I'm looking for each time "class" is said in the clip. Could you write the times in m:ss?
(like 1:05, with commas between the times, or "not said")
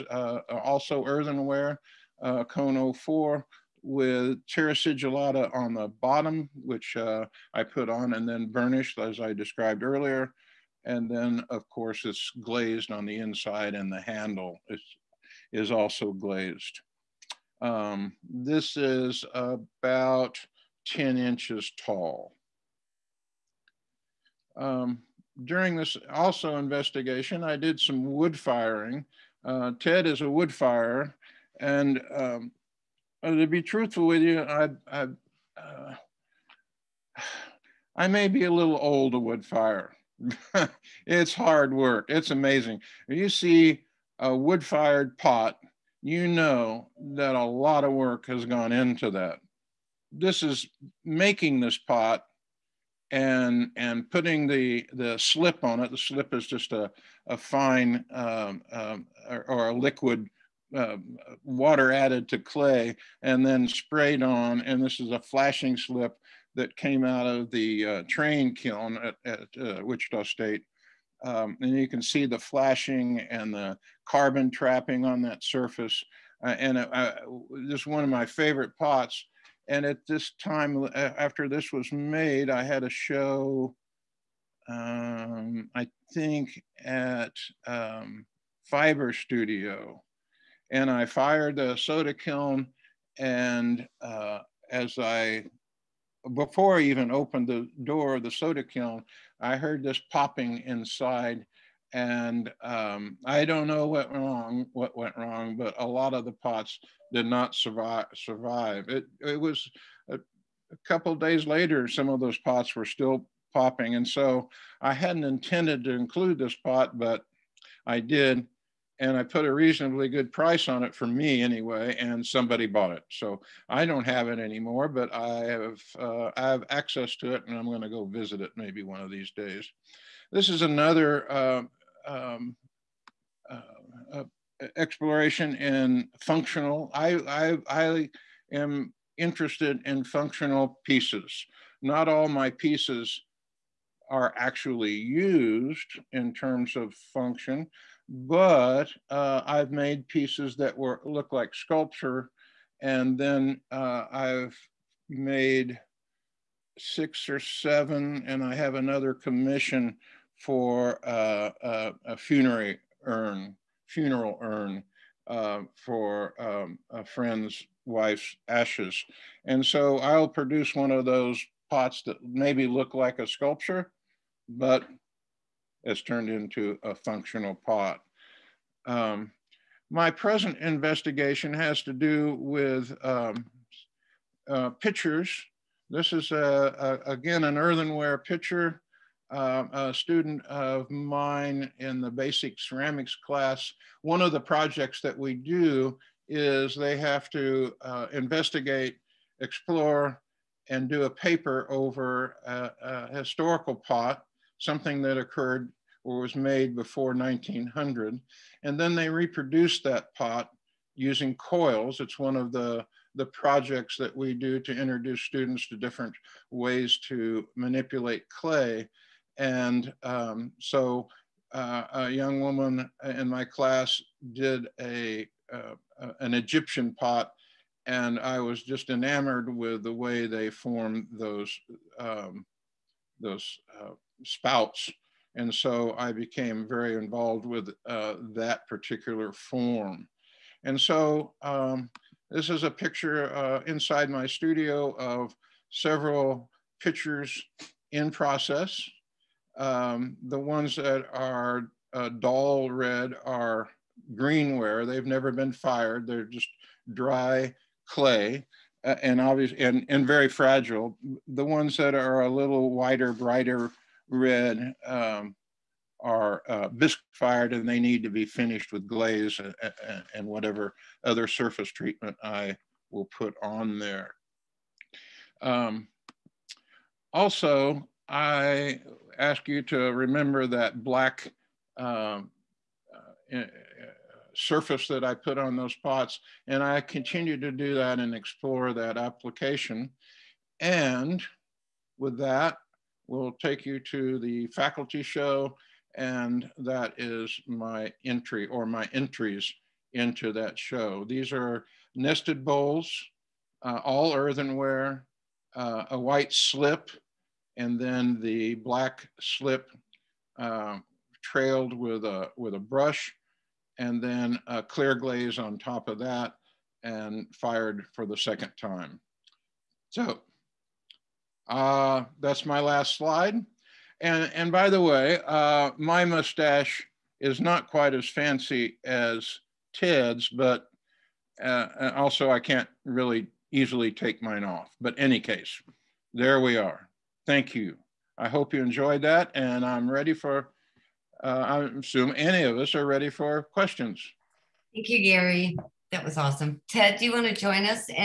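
3:13, 3:43.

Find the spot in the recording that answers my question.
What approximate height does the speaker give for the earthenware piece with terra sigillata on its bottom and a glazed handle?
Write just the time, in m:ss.
0:20.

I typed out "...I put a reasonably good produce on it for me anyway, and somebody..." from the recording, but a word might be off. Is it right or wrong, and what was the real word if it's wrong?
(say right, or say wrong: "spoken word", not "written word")
wrong: "price", not "produce".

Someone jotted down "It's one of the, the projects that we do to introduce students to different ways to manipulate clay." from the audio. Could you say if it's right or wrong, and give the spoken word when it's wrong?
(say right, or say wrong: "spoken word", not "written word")
right.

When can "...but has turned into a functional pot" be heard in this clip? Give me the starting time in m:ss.
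2:54.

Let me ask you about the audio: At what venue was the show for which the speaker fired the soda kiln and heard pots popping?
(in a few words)
Fiber Studio.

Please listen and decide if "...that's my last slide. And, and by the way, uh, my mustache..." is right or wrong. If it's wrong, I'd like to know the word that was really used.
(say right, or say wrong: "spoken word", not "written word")
right.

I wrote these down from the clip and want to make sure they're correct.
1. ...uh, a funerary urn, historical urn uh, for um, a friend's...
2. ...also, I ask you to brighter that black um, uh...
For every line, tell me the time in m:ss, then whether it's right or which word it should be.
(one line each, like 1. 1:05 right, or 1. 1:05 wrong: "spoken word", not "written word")
1. 2:41 wrong: "funeral", not "historical"
2. 4:37 wrong: "remember", not "brighter".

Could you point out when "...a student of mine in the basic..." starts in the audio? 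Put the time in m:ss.
3:09.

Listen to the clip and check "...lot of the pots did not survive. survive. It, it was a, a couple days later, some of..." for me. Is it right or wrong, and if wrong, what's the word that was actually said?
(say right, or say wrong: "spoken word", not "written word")
right.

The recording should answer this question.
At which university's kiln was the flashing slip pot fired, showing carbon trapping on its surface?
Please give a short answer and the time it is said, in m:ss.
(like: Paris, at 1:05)
Wichita State, at 1:09.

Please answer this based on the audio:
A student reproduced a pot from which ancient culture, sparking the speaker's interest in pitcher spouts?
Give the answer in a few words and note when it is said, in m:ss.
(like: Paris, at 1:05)
Egyptian, at 3:46.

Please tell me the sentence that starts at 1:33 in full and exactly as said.
And uh, as I, before I even opened the door of the soda kiln, I heard this popping inside.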